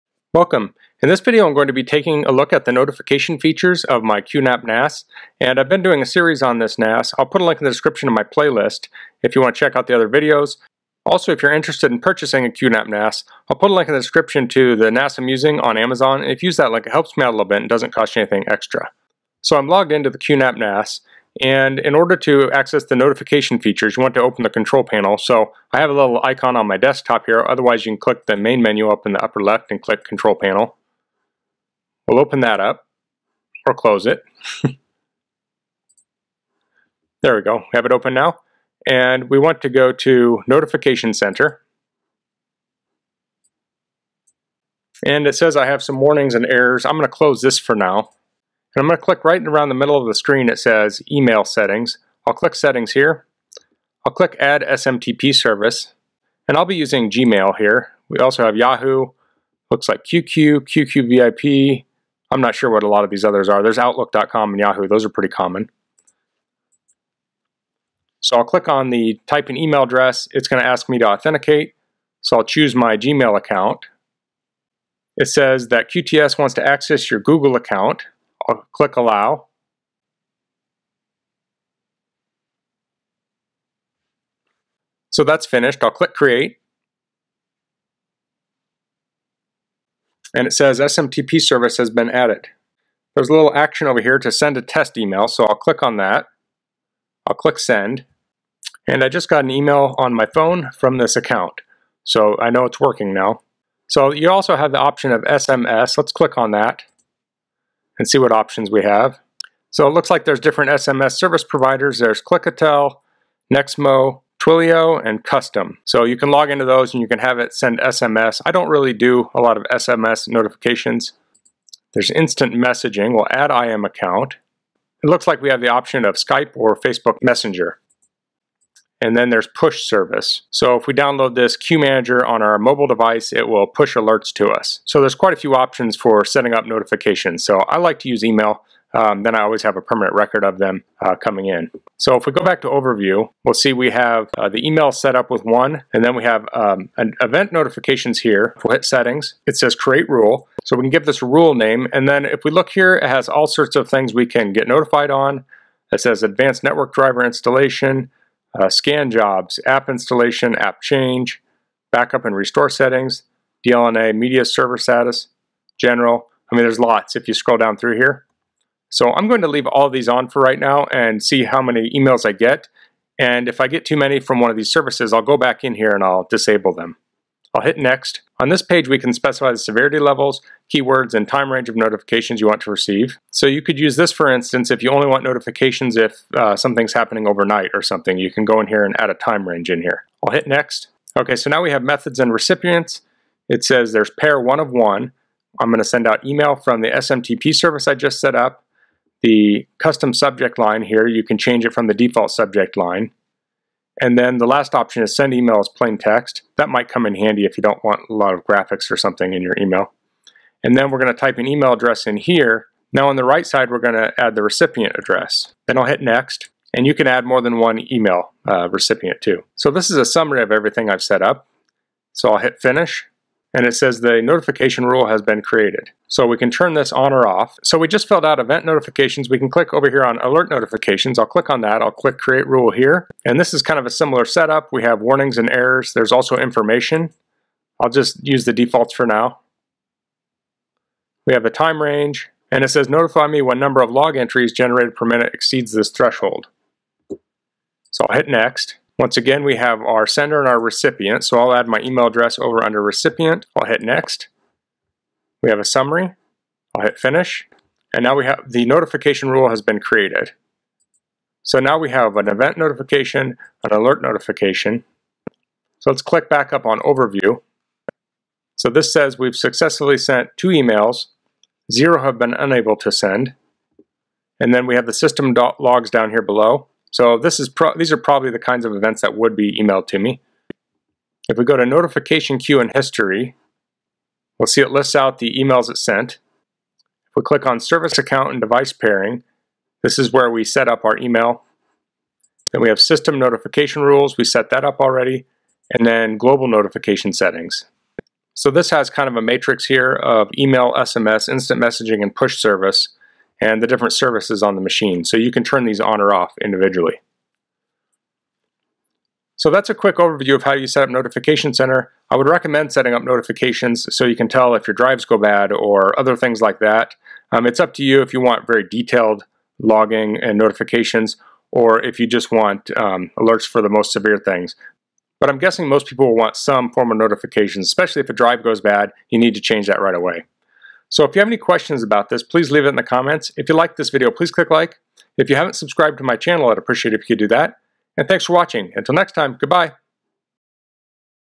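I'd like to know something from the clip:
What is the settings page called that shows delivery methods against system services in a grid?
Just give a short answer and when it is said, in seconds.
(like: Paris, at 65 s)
Global notification settings, at 296 s.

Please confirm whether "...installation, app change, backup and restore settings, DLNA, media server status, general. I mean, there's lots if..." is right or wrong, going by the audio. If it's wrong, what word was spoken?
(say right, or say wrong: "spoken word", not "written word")
right.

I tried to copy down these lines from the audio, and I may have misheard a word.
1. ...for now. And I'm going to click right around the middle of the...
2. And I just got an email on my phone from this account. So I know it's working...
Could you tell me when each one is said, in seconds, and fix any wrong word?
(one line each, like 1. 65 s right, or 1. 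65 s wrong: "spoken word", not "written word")
1. 47 s right
2. 98 s right.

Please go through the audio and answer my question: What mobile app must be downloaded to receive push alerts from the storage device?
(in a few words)
Qmanager.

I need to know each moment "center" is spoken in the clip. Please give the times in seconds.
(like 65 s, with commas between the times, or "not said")
41 s, 311 s.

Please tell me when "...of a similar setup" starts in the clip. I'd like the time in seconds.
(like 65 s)
233 s.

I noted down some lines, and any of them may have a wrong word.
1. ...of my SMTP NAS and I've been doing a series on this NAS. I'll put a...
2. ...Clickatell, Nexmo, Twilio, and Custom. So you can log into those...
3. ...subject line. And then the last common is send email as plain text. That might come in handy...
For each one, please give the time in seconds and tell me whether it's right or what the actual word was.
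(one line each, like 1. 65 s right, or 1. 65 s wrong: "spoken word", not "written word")
1. 3 s wrong: "QNAP", not "SMTP"
2. 112 s right
3. 202 s wrong: "option", not "common".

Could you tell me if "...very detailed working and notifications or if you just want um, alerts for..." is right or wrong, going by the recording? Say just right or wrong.
wrong.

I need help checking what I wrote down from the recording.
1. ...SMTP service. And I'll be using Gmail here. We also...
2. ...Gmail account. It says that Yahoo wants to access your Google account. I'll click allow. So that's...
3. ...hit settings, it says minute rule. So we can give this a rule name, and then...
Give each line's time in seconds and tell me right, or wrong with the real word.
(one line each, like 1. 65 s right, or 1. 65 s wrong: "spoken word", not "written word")
1. 54 s right
2. 72 s wrong: "QTS", not "Yahoo"
3. 148 s wrong: "create", not "minute".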